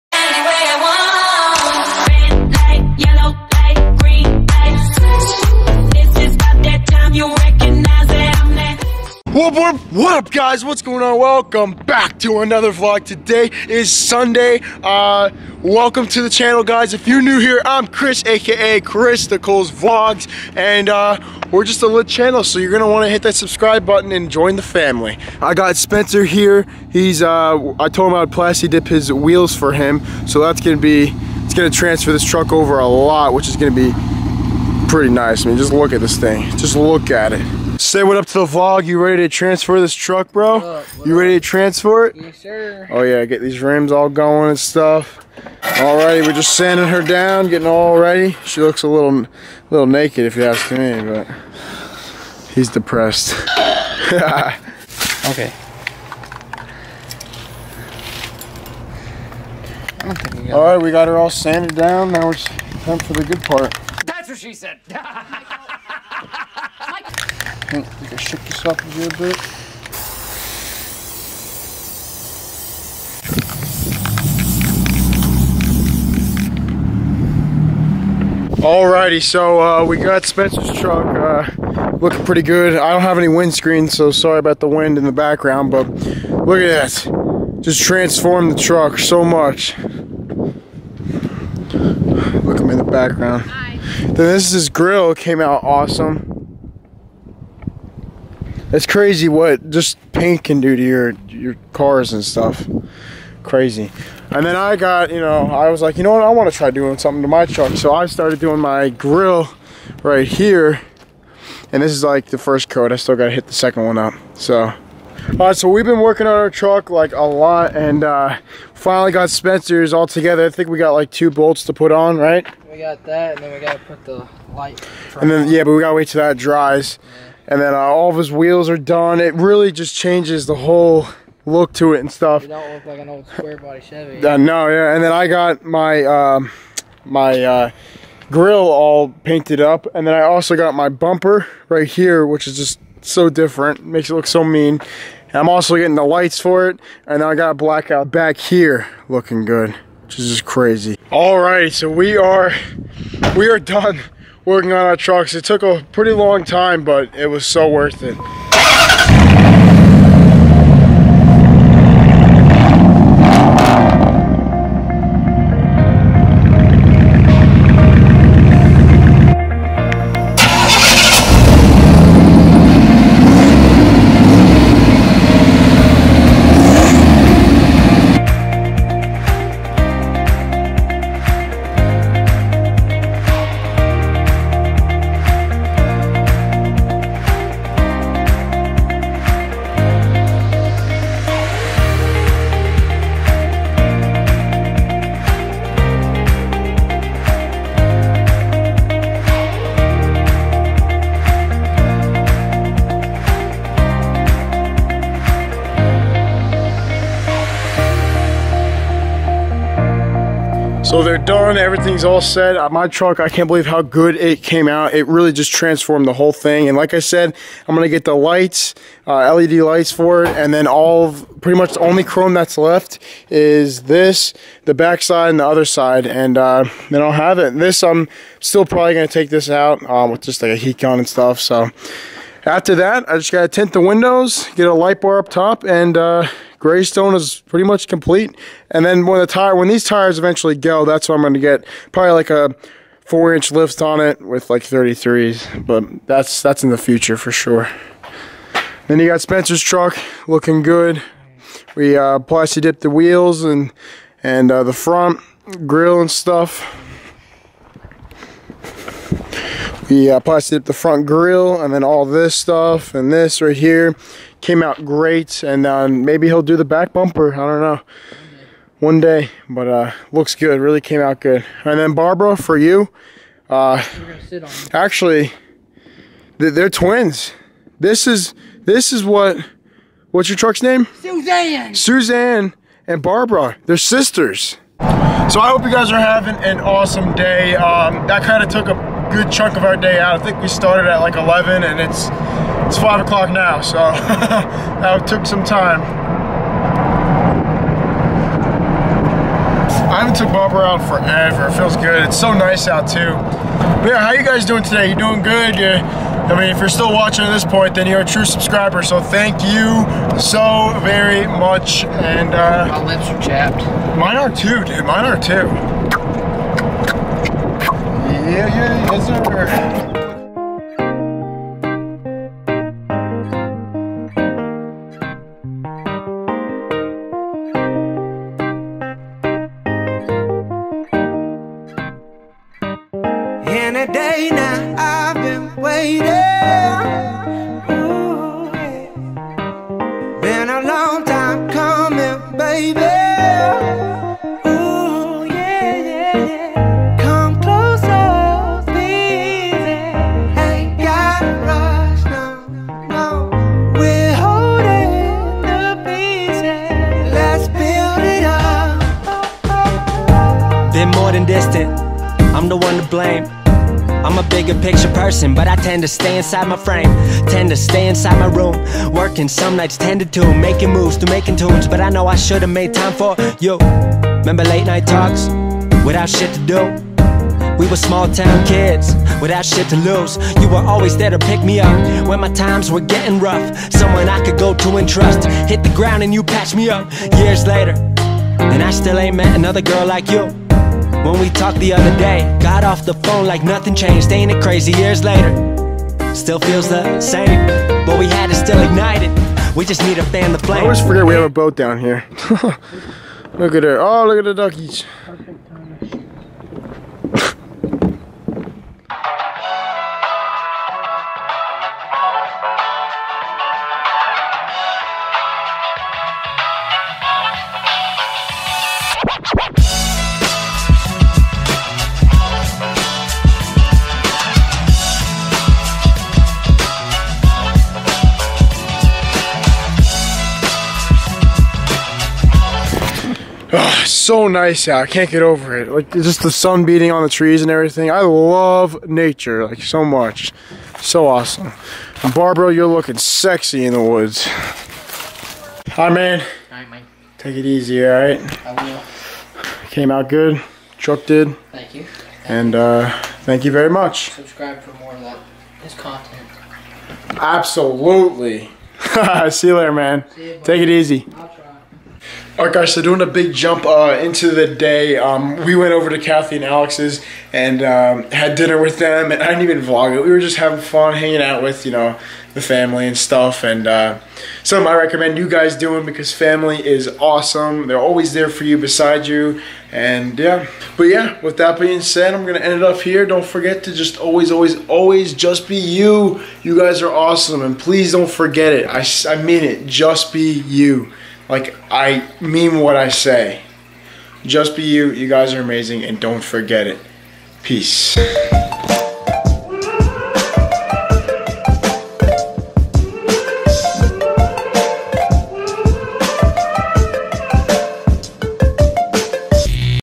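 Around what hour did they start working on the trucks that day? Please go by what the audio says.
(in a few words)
11.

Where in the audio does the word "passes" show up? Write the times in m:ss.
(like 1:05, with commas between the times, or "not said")
not said.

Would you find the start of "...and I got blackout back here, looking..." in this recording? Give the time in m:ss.
2:27.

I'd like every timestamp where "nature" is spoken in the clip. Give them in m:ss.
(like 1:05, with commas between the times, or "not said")
7:18.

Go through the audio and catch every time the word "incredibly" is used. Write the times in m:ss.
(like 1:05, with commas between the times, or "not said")
not said.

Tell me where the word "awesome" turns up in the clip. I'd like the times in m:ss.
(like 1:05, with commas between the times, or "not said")
1:35, 4:46, 7:21, 7:57, 8:06.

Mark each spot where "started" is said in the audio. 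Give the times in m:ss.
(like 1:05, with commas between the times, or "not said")
1:48, 4:50.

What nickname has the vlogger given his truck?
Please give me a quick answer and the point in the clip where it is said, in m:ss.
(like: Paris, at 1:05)
Greystone, at 3:56.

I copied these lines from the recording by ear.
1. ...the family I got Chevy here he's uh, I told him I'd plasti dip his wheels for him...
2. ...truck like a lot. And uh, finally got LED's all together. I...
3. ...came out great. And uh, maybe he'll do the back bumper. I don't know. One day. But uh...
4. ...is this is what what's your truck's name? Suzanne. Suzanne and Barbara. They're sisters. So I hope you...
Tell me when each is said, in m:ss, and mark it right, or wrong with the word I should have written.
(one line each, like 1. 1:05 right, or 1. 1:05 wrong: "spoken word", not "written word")
1. 0:24 wrong: "Spencer", not "Chevy"
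2. 1:56 wrong: "Spencer", not "LED"
3. 4:24 right
4. 4:38 right.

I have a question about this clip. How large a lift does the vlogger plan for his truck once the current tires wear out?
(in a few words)
4 inch.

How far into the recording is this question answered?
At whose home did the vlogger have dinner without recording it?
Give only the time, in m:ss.
7:45.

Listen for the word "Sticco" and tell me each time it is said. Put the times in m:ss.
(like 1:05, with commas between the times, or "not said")
0:19.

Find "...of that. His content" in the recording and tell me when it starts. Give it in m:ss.
7:34.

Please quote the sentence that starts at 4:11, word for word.
We uh, plasti dipped the wheels and and uh, the front grill and stuff.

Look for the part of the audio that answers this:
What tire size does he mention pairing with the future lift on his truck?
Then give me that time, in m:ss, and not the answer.
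4:04.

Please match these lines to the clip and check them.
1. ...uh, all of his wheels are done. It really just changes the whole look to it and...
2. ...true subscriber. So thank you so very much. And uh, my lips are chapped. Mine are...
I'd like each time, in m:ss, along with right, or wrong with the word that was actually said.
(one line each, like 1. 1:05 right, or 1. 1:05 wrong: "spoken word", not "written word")
1. 2:07 right
2. 5:08 right.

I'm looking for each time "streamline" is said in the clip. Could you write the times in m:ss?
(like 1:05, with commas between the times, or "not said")
not said.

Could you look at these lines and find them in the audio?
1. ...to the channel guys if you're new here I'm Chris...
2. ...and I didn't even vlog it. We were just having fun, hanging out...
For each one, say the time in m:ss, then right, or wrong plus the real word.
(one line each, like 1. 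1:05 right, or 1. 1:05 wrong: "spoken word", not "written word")
1. 0:16 right
2. 7:49 right.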